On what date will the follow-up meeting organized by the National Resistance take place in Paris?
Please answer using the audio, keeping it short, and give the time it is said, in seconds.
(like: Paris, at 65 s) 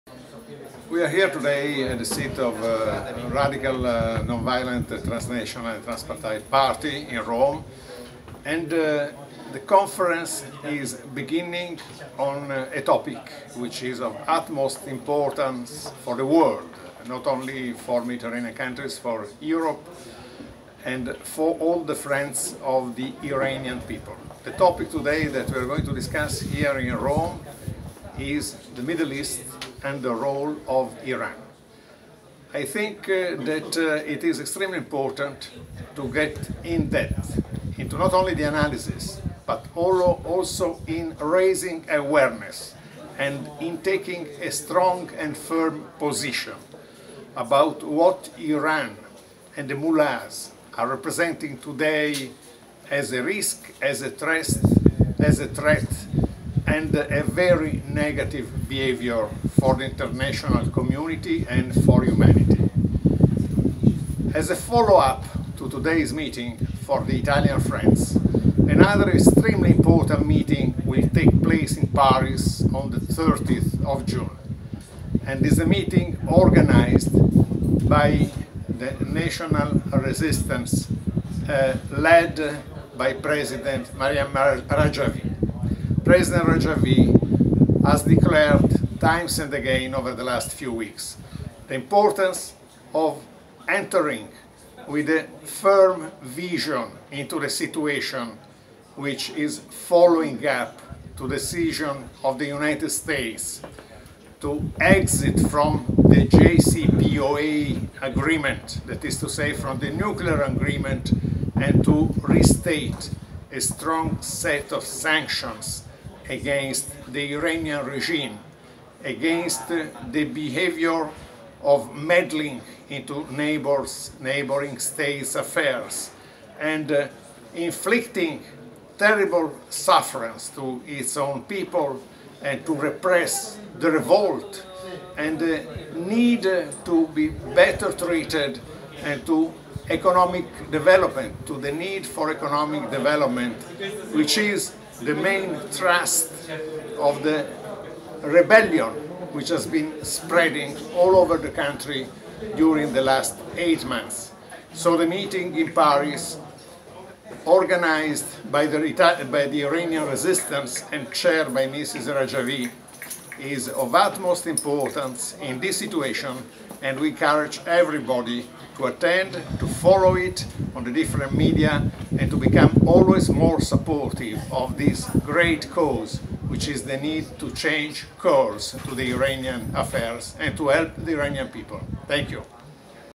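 30th of June, at 72 s.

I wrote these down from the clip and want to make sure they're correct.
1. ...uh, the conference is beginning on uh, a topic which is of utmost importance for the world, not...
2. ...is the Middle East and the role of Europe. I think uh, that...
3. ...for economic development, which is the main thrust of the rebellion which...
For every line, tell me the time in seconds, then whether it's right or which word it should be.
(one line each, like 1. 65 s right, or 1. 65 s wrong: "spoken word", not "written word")
1. 8 s right
2. 28 s wrong: "Iran", not "Europe"
3. 142 s right.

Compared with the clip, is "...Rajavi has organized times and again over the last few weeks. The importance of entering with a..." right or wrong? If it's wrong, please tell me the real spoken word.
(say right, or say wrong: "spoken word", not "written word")
wrong: "declared", not "organized".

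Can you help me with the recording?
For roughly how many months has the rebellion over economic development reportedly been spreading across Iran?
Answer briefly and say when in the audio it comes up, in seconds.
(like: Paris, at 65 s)
8, at 153 s.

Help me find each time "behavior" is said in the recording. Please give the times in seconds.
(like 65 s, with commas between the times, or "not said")
58 s, 120 s.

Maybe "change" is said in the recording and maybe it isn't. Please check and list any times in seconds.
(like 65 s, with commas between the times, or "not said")
177 s.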